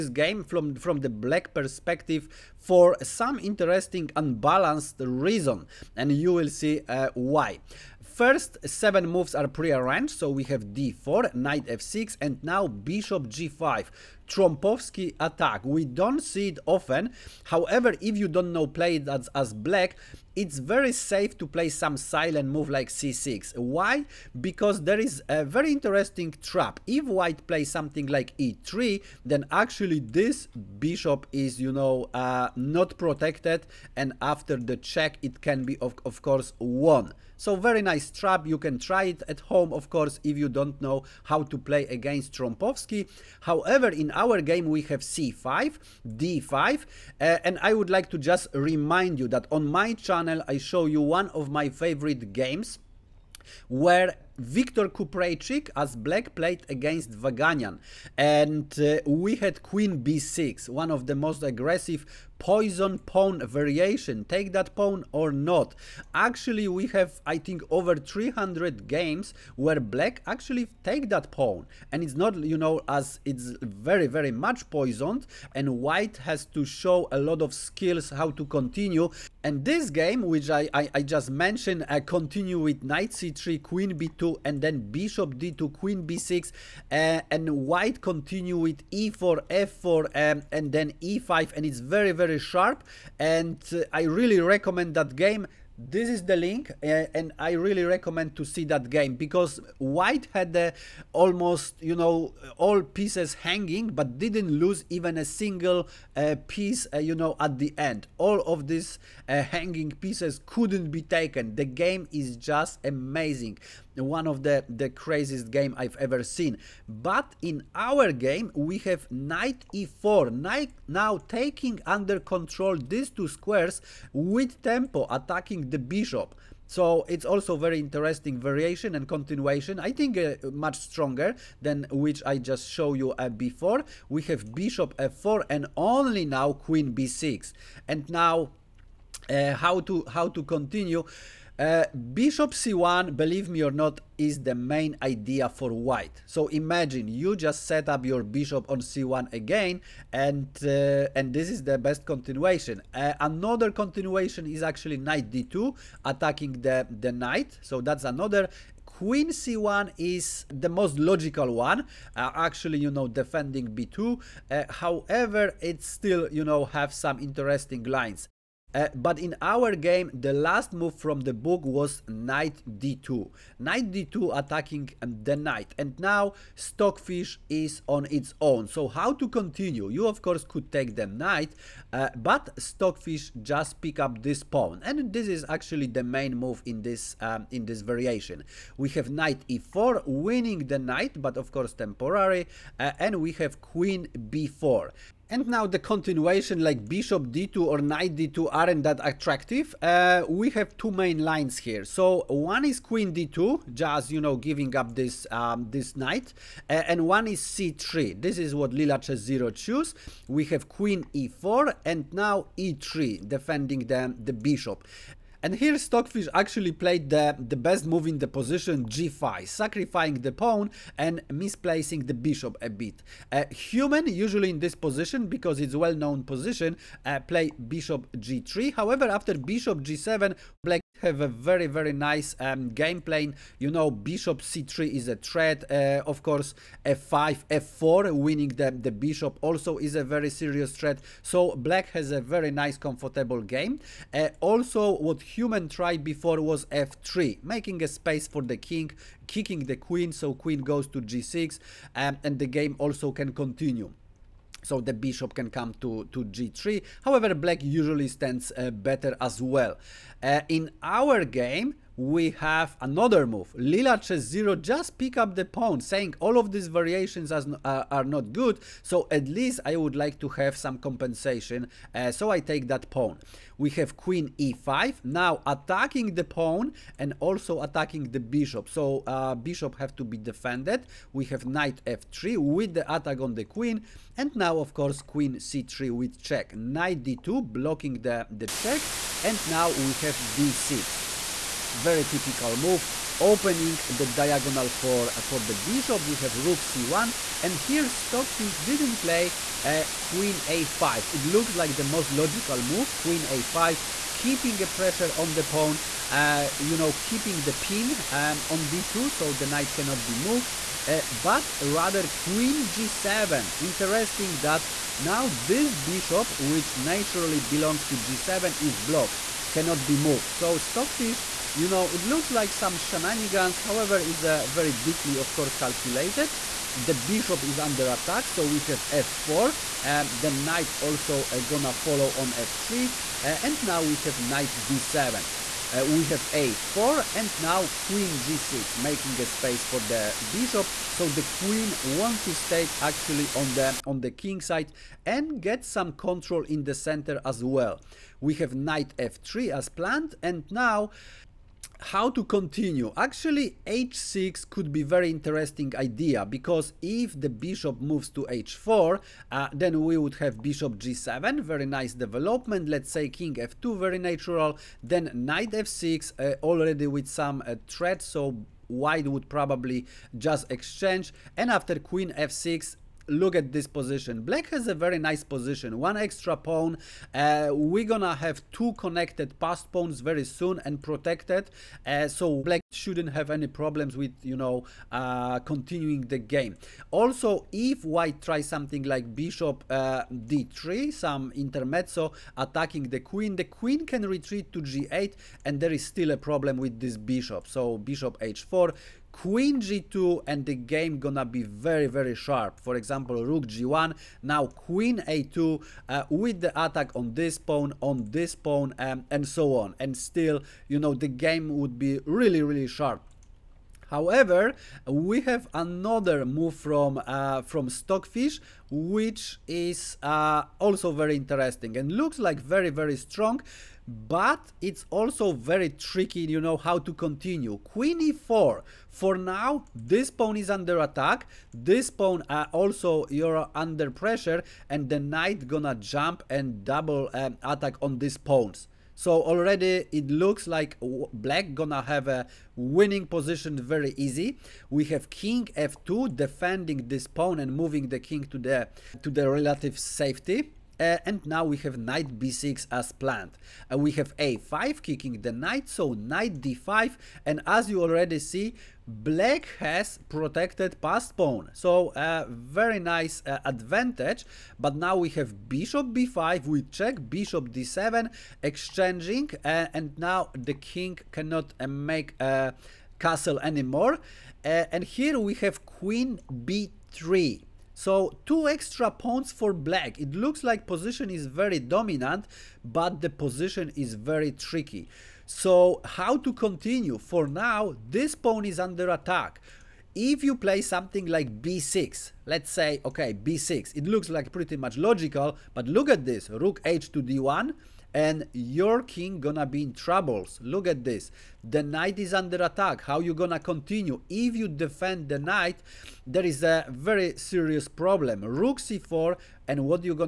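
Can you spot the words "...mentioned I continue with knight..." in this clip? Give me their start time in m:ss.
1:21.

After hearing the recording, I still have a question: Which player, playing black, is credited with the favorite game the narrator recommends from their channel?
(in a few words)
Viktor Kupreichik.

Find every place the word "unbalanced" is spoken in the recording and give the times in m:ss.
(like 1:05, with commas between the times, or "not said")
0:04.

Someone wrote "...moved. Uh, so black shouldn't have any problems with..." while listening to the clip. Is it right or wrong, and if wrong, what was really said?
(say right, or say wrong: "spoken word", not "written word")
wrong: "protected", not "moved".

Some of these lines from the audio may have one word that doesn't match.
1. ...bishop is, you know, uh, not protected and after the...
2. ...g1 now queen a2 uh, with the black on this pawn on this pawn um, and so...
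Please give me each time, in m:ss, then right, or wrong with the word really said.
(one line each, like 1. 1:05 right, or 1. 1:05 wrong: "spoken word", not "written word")
1. 0:30 right
2. 6:43 wrong: "attack", not "black".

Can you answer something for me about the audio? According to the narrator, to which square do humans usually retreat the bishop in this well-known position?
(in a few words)
g3.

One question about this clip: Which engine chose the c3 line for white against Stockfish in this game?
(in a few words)
Leela Chess0.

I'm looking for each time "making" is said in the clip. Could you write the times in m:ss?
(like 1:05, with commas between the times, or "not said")
4:07, 5:38.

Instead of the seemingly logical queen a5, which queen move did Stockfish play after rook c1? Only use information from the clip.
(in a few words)
queen g7.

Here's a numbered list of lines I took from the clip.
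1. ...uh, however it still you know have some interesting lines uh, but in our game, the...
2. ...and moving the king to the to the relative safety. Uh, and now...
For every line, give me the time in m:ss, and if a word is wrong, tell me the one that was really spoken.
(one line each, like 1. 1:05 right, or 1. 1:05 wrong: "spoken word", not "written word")
1. 2:44 right
2. 7:27 right.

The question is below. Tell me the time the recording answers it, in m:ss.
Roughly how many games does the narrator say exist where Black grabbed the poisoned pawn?
1:07.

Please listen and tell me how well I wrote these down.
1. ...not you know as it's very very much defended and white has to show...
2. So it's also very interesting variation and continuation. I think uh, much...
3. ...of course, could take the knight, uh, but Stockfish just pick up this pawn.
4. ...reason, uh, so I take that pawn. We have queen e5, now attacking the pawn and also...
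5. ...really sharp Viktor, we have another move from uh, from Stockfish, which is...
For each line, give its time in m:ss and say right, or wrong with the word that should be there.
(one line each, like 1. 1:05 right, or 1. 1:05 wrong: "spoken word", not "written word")
1. 1:12 wrong: "poisoned", not "defended"
2. 2:06 right
3. 3:00 right
4. 4:30 wrong: "compensation", not "reason"
5. 6:52 wrong: "However", not "Viktor".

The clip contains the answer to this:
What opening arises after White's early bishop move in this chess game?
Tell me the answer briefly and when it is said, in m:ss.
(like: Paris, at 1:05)
Trompowsky attack, at 0:14.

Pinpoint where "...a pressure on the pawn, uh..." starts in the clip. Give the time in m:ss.
5:04.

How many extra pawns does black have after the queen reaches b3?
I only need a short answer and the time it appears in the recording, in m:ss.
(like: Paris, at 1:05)
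2, at 7:58.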